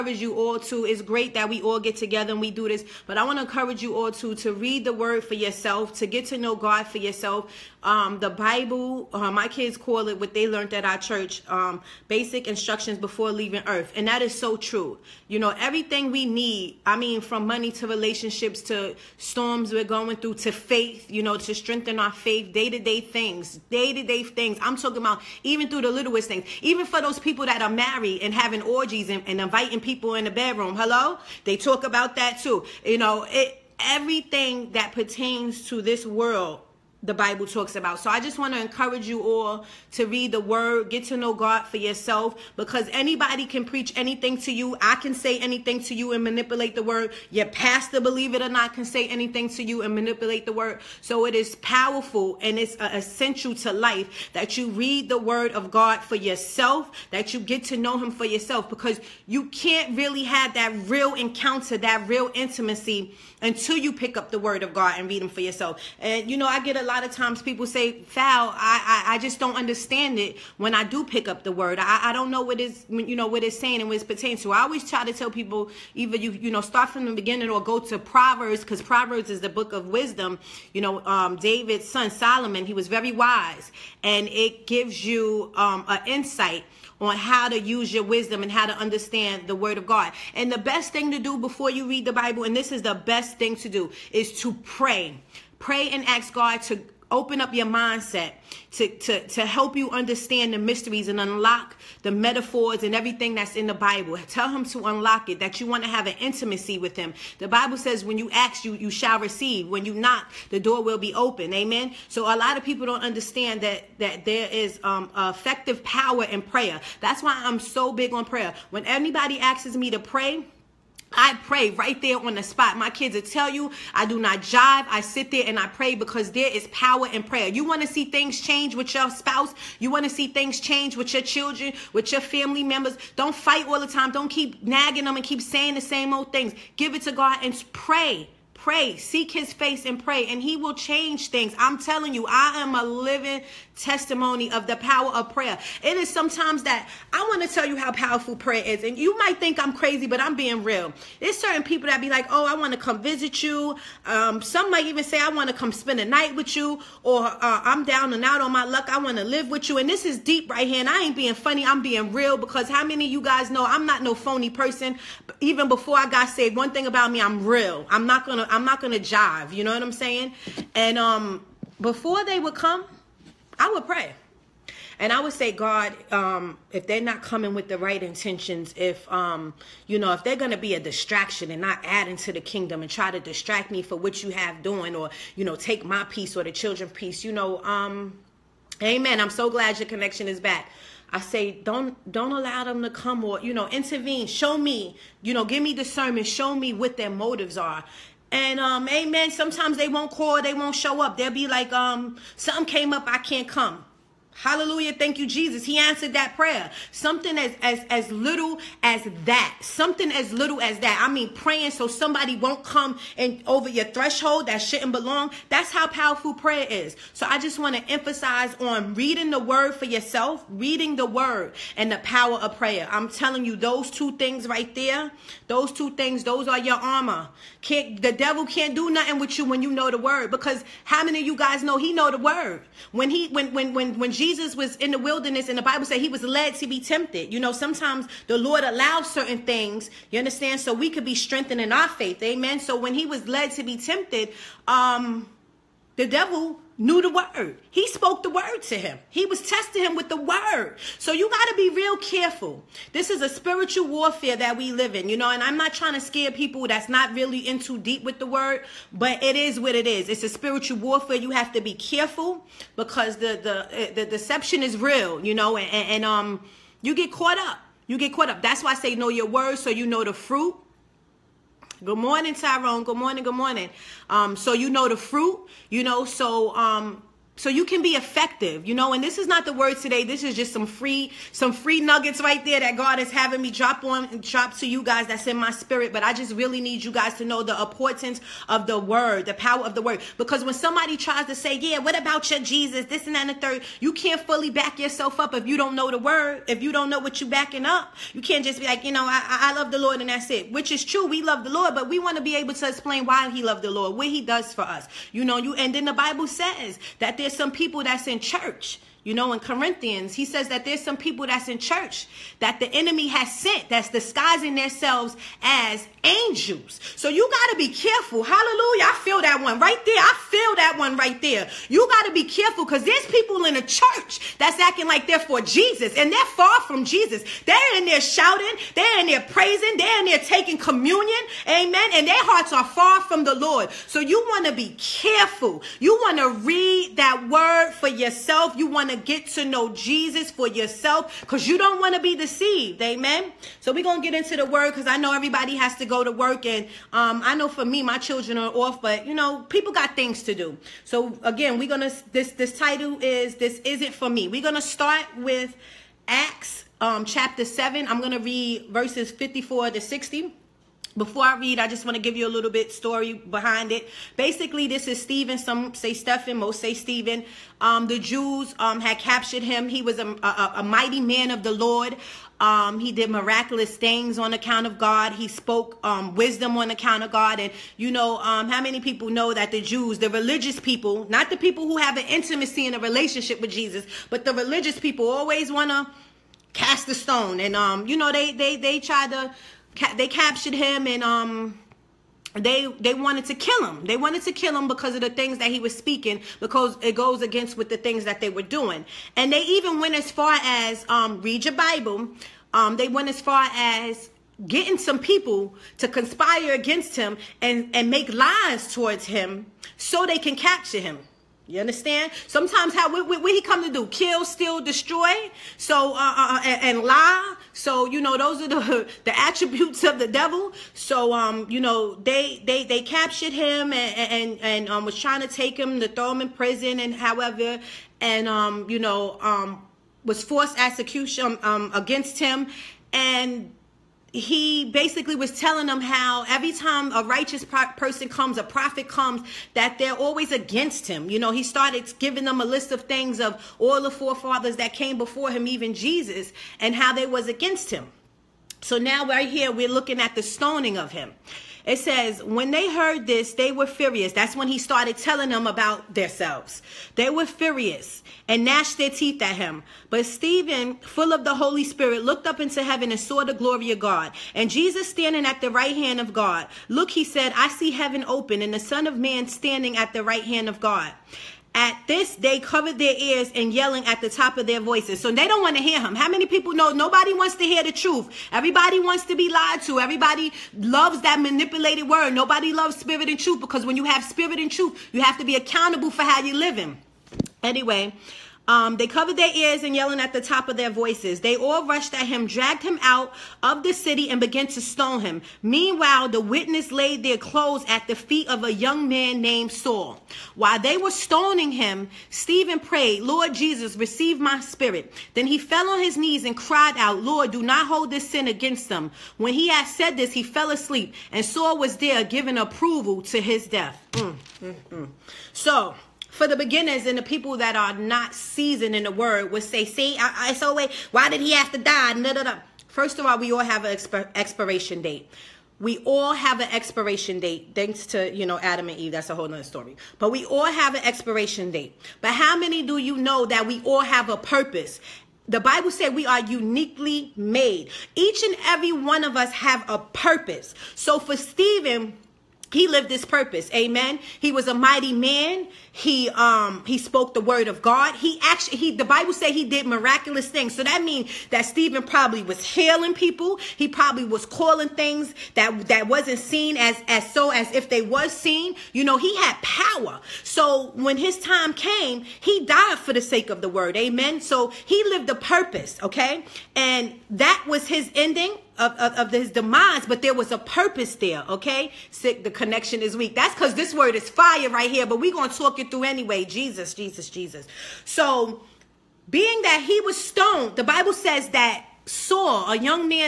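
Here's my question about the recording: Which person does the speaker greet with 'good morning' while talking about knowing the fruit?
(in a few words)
Tyrone.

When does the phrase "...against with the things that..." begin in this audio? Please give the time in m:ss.
6:37.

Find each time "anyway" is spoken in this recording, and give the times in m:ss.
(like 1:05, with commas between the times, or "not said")
8:07, 9:35.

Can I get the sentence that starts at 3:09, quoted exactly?
I'm so glad your connection is back.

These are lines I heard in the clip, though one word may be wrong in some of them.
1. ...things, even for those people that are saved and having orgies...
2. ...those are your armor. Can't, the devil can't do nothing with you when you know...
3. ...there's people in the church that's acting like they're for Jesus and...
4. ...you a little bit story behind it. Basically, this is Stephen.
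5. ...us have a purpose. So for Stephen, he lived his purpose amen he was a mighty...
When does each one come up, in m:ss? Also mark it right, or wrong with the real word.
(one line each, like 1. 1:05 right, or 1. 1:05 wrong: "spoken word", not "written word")
1. 0:26 wrong: "married", not "saved"
2. 3:46 right
3. 5:22 right
4. 6:02 right
5. 8:59 right.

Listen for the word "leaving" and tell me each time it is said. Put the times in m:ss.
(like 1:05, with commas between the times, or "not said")
0:13.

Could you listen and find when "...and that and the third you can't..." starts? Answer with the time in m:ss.
4:53.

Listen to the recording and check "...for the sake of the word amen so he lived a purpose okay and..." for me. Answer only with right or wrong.
right.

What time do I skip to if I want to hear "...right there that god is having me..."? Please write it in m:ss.
4:42.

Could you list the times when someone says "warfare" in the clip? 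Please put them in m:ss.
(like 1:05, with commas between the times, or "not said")
4:13, 4:20.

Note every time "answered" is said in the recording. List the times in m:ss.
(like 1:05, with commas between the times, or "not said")
3:25.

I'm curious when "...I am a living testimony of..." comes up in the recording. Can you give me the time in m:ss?
2:22.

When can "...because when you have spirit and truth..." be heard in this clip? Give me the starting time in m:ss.
8:03.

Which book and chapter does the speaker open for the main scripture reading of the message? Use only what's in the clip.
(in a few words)
Acts chapter 7.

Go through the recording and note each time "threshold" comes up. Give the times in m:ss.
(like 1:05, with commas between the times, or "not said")
3:33.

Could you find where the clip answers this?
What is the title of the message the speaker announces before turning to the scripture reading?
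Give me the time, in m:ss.
5:53.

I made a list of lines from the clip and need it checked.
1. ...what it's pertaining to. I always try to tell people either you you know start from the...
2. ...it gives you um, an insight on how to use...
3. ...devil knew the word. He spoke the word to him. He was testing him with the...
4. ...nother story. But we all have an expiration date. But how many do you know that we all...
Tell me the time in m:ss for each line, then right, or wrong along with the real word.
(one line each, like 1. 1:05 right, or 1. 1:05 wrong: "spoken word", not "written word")
1. 1:13 right
2. 1:24 right
3. 4:06 right
4. 8:49 right.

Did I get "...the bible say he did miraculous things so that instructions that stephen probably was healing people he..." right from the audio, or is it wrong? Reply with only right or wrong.
wrong.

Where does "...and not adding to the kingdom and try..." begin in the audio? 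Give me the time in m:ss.
3:01.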